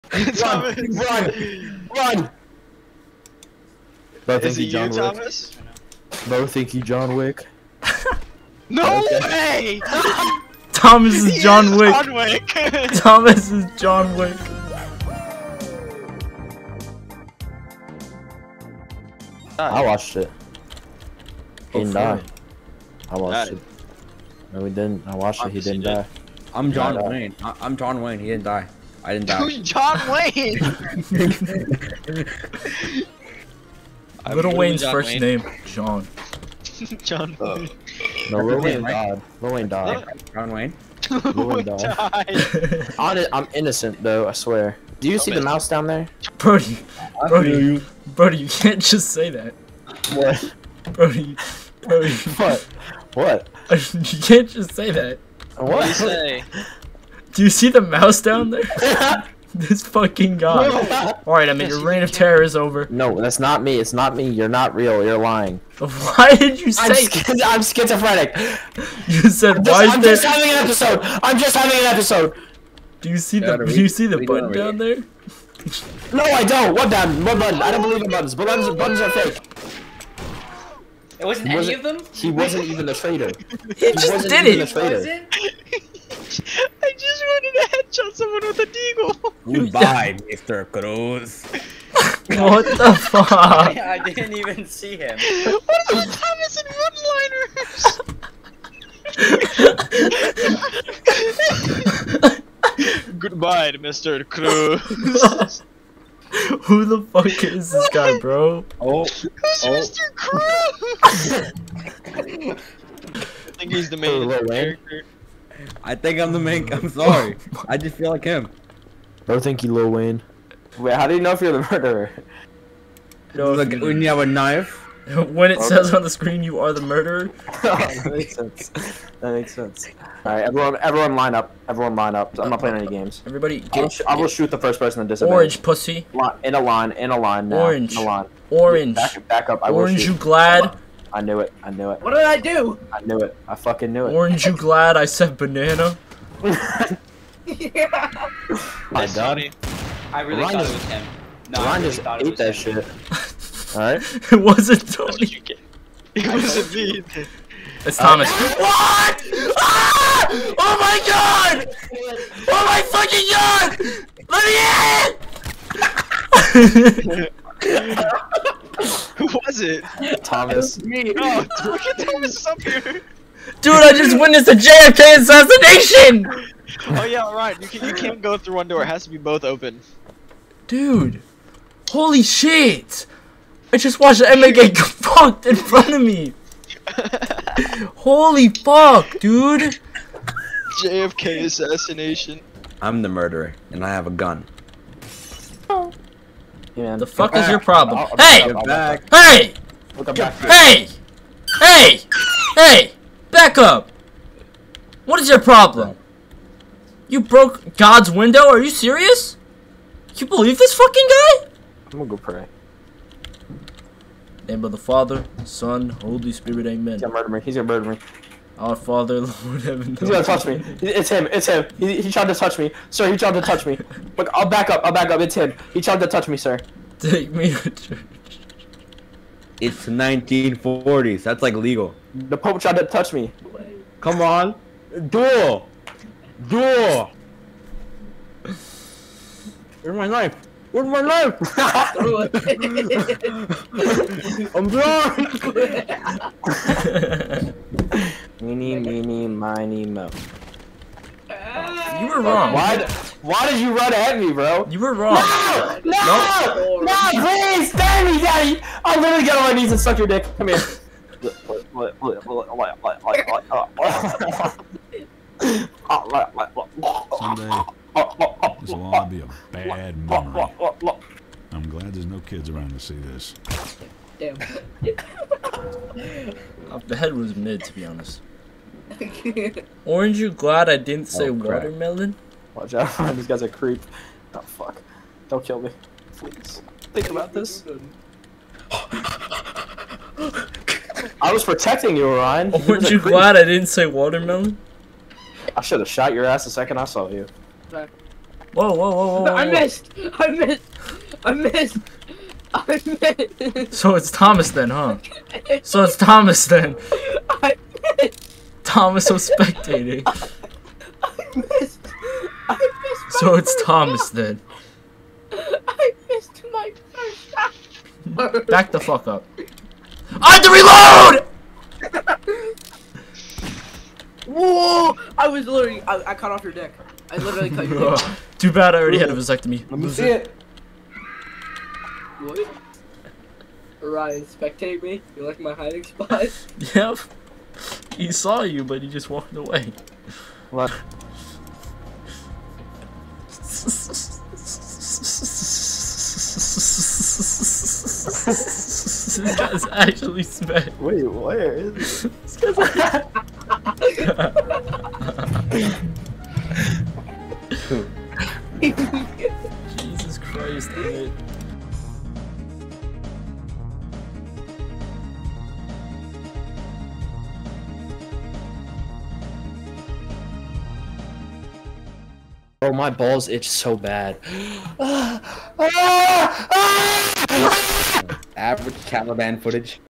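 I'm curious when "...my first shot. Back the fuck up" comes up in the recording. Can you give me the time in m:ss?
5:16.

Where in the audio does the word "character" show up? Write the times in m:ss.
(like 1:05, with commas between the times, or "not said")
1:54.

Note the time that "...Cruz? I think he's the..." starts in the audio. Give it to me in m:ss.
1:50.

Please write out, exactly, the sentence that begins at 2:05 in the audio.
says on the screen you are the murderer.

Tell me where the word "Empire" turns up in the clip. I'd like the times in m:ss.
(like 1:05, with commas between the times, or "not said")
not said.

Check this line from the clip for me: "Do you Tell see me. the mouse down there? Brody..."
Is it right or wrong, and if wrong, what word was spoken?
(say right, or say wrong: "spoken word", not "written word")
right.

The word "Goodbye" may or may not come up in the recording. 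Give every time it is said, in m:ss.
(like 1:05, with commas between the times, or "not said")
1:29, 1:43.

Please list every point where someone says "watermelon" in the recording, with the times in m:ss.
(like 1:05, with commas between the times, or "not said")
4:41, 4:53.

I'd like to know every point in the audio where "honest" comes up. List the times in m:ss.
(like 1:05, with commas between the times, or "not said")
0:42, 4:37.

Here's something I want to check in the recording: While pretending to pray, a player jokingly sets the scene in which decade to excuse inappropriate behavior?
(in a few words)
1940s.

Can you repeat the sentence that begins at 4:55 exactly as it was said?
I should have shot your ass the second I saw you.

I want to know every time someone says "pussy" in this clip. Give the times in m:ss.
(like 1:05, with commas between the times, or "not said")
2:15.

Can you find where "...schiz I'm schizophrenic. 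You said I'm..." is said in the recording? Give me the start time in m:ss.
1:06.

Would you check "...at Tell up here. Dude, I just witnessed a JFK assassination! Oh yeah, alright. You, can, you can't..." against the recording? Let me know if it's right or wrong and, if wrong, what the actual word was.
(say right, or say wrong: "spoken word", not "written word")
wrong: "Thomas", not "Tell".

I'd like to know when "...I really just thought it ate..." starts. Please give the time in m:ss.
2:31.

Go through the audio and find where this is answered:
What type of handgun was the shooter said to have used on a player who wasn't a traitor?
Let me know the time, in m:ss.
1:28.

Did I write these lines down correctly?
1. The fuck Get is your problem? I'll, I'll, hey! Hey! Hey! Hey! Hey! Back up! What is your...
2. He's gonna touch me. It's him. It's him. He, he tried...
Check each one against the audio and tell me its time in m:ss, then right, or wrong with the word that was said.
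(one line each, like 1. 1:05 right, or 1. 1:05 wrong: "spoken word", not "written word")
1. 3:16 right
2. 3:39 right.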